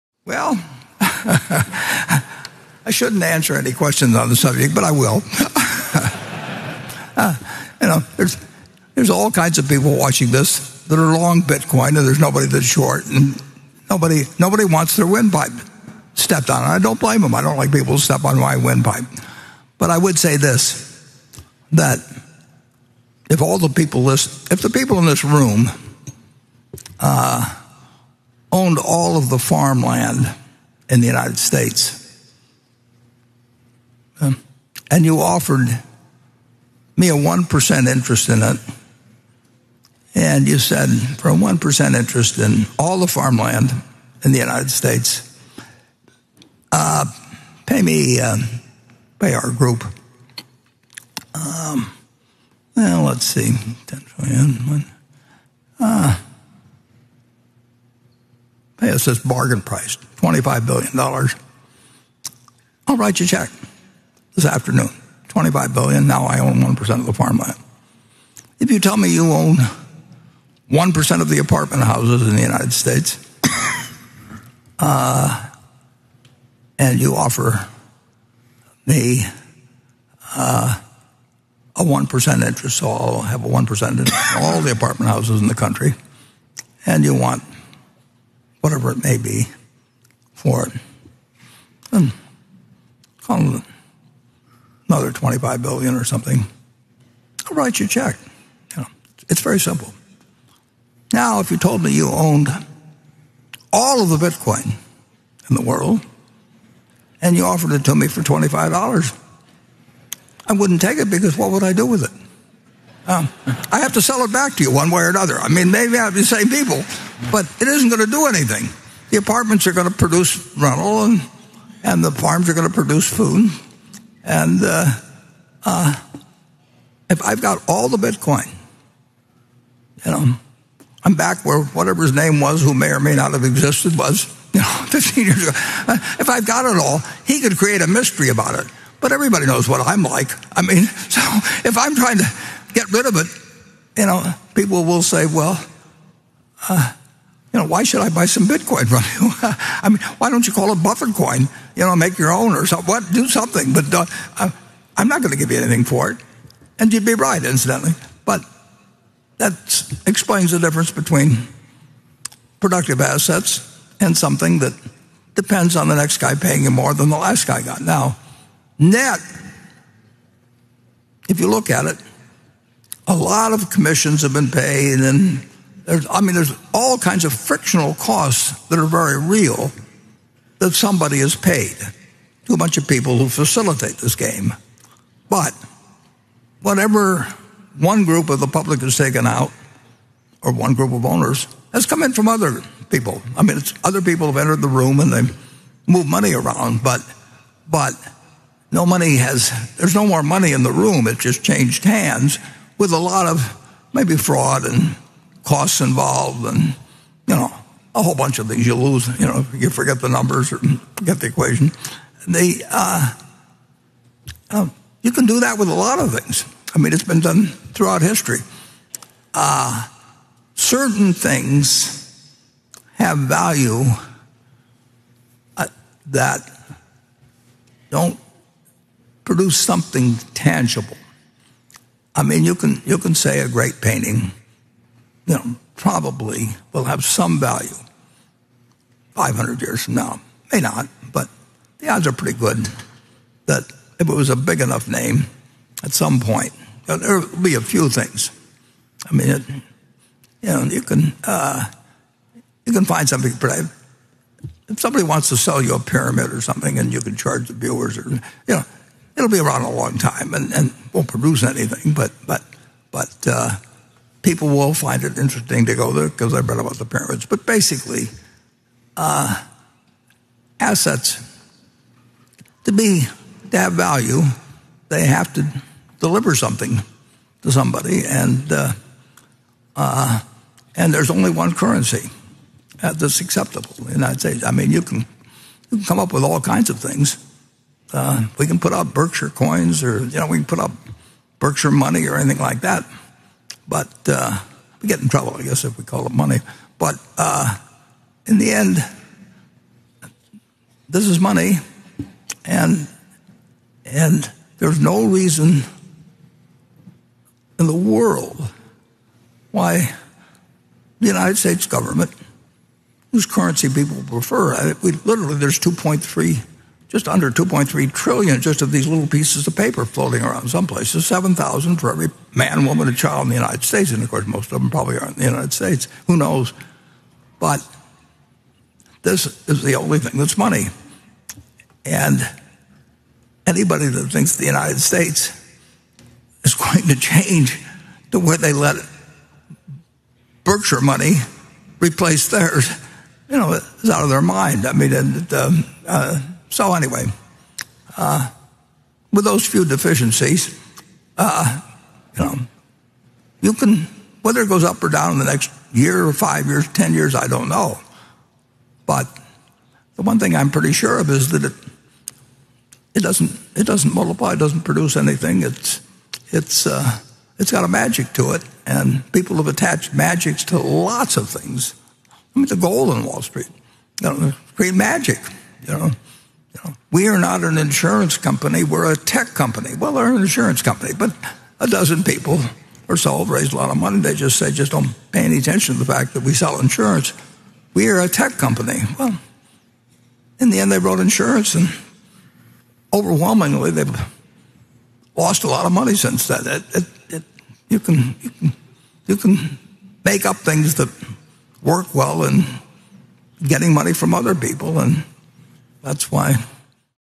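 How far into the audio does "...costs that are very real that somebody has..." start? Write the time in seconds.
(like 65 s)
177 s.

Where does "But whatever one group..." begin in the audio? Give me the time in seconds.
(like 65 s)
185 s.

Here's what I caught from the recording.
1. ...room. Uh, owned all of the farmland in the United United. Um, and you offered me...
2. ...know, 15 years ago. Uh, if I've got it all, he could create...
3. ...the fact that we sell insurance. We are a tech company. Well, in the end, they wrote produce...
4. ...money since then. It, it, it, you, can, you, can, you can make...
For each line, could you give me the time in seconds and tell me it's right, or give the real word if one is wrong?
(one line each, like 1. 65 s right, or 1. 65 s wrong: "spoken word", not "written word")
1. 25 s wrong: "States", not "United"
2. 134 s right
3. 385 s wrong: "insurance", not "produce"
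4. 395 s right.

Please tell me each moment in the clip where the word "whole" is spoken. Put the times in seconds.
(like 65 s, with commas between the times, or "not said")
208 s.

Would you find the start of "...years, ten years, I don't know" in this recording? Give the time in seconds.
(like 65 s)
356 s.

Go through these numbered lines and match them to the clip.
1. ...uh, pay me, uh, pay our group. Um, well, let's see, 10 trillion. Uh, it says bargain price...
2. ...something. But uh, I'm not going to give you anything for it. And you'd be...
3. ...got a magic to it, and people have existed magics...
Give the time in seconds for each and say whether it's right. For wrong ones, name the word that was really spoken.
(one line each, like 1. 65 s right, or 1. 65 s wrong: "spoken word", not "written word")
1. 46 s right
2. 153 s right
3. 367 s wrong: "attached", not "existed".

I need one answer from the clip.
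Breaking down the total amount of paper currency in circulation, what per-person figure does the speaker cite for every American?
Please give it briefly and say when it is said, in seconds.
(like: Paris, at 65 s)
7,000, at 321 s.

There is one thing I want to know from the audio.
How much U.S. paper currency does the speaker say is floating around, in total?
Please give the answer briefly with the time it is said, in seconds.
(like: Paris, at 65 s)
just under 2.3 trillion, at 316 s.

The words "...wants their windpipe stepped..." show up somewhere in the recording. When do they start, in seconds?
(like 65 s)
14 s.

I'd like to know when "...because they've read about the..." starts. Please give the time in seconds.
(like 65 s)
266 s.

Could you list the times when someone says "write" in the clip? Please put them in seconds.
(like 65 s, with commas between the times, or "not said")
62 s, 97 s.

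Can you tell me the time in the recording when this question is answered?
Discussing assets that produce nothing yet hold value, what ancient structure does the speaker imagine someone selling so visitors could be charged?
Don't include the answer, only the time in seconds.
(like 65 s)
255 s.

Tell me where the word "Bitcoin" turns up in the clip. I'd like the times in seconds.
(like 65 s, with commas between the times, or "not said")
11 s, 104 s, 127 s, 148 s.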